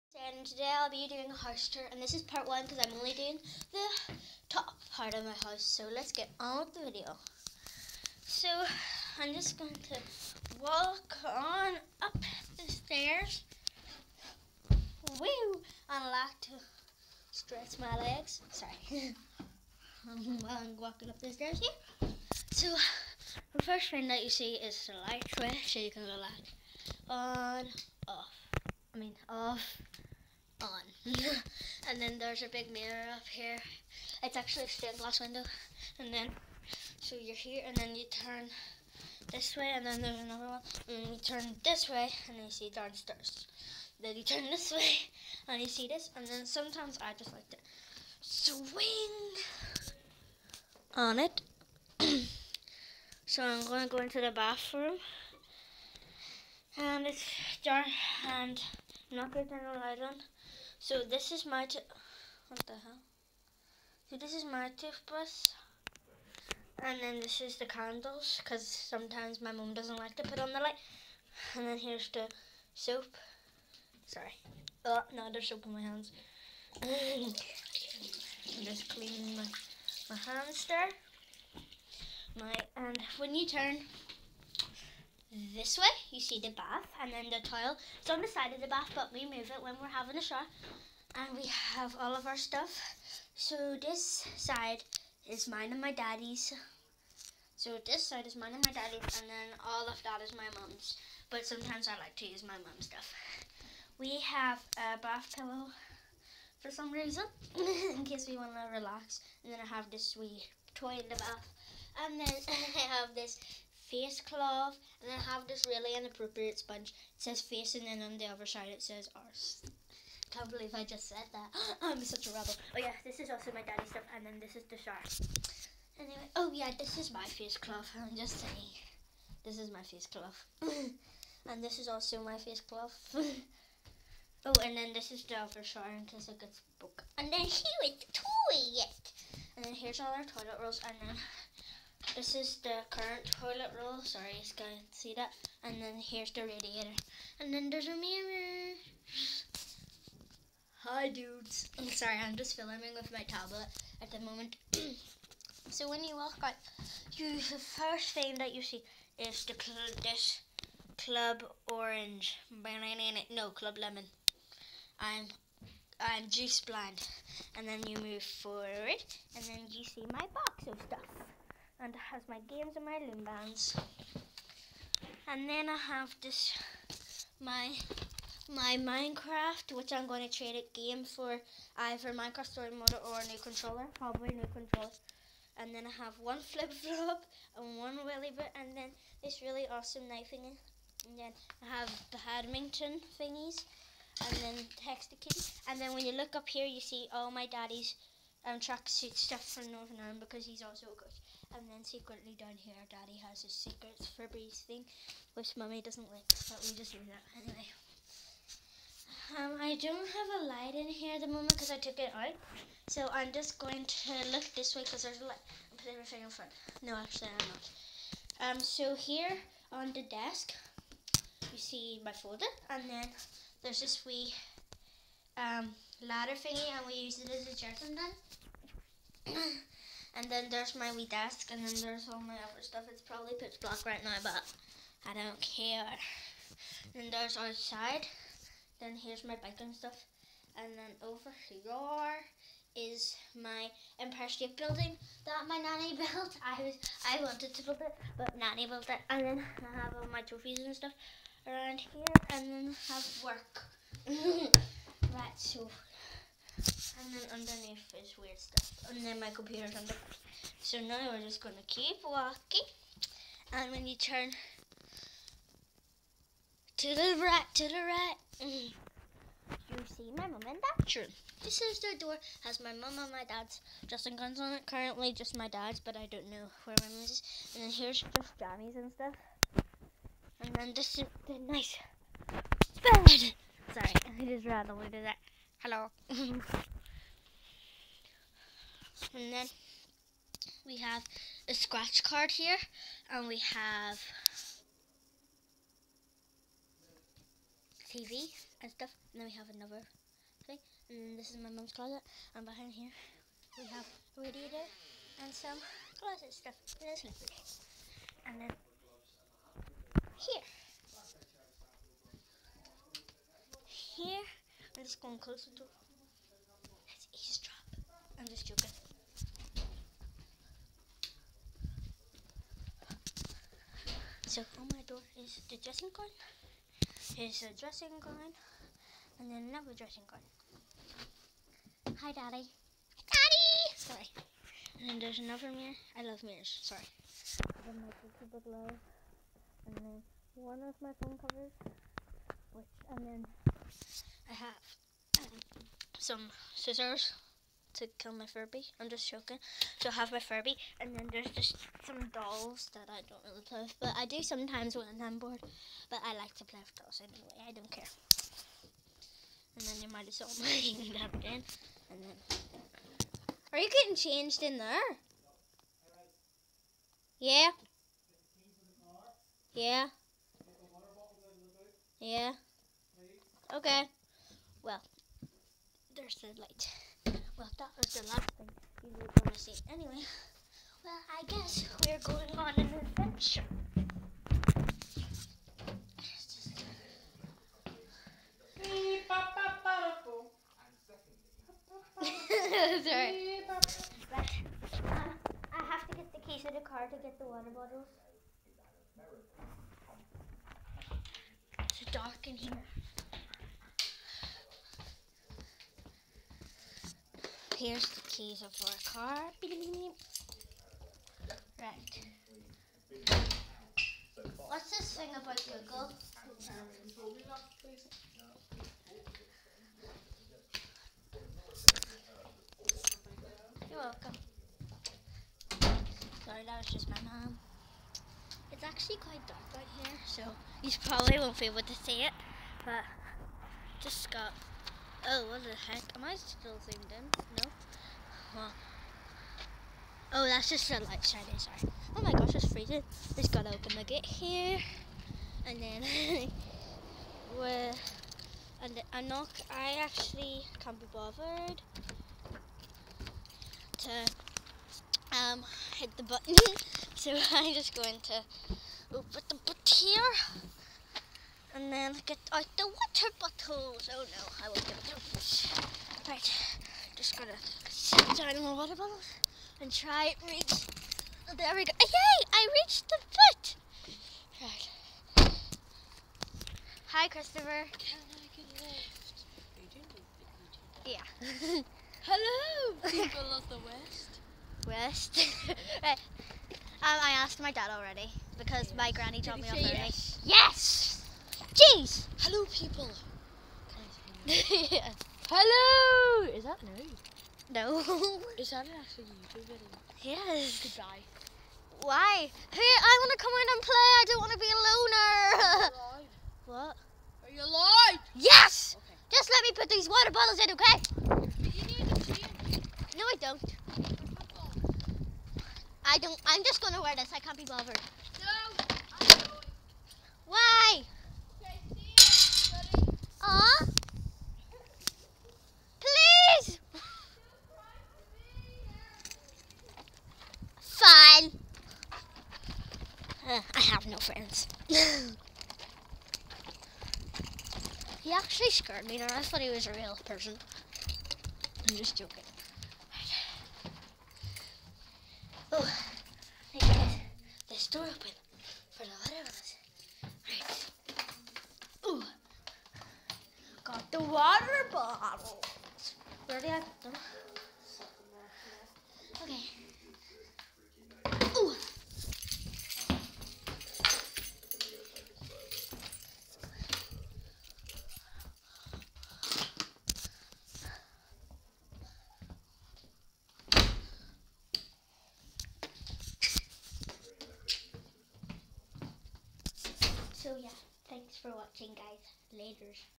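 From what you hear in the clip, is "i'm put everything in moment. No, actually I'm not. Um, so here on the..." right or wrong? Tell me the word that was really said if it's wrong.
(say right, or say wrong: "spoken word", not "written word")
wrong: "front", not "moment".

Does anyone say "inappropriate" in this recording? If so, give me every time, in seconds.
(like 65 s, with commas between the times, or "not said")
115 s.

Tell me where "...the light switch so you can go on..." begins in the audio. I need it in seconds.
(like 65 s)
24 s.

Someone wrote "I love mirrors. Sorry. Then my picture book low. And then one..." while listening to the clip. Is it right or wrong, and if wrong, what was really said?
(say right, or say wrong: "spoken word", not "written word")
right.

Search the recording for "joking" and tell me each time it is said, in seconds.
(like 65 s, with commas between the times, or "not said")
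318 s, 349 s, 541 s.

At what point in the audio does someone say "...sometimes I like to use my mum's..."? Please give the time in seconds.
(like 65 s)
101 s.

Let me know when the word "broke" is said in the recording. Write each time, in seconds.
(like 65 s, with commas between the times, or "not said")
136 s.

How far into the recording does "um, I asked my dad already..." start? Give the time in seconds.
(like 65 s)
486 s.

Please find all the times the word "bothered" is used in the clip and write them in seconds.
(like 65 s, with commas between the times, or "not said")
450 s, 517 s.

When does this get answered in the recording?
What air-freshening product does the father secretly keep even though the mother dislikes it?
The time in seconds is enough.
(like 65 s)
204 s.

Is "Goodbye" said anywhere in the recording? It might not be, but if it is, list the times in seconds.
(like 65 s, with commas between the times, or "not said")
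500 s.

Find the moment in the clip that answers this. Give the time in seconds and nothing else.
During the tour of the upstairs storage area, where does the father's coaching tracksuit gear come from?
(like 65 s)
199 s.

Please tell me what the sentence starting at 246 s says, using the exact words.
I was I wanted to build it, but nanny built it.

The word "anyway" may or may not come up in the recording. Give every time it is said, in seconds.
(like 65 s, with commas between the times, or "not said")
125 s, 207 s, 357 s, 379 s.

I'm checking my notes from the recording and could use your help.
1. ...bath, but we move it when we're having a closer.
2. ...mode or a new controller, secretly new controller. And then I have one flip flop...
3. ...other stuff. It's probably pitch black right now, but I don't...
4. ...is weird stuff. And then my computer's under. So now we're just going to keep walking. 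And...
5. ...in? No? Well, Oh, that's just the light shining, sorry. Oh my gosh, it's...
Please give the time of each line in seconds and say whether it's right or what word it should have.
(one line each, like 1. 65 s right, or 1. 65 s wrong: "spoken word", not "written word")
1. 88 s wrong: "shower", not "closer"
2. 182 s wrong: "probably", not "secretly"
3. 232 s right
4. 257 s right
5. 436 s right.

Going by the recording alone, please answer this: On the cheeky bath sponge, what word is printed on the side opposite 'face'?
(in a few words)
arse.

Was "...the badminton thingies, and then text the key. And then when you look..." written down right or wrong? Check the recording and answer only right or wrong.
right.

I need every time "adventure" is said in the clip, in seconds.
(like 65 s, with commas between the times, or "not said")
382 s.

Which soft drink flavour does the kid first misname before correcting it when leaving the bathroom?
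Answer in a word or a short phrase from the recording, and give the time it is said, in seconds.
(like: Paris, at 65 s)
Club Lemon, at 163 s.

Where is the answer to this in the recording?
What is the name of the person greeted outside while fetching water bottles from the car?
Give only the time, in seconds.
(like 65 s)
477 s.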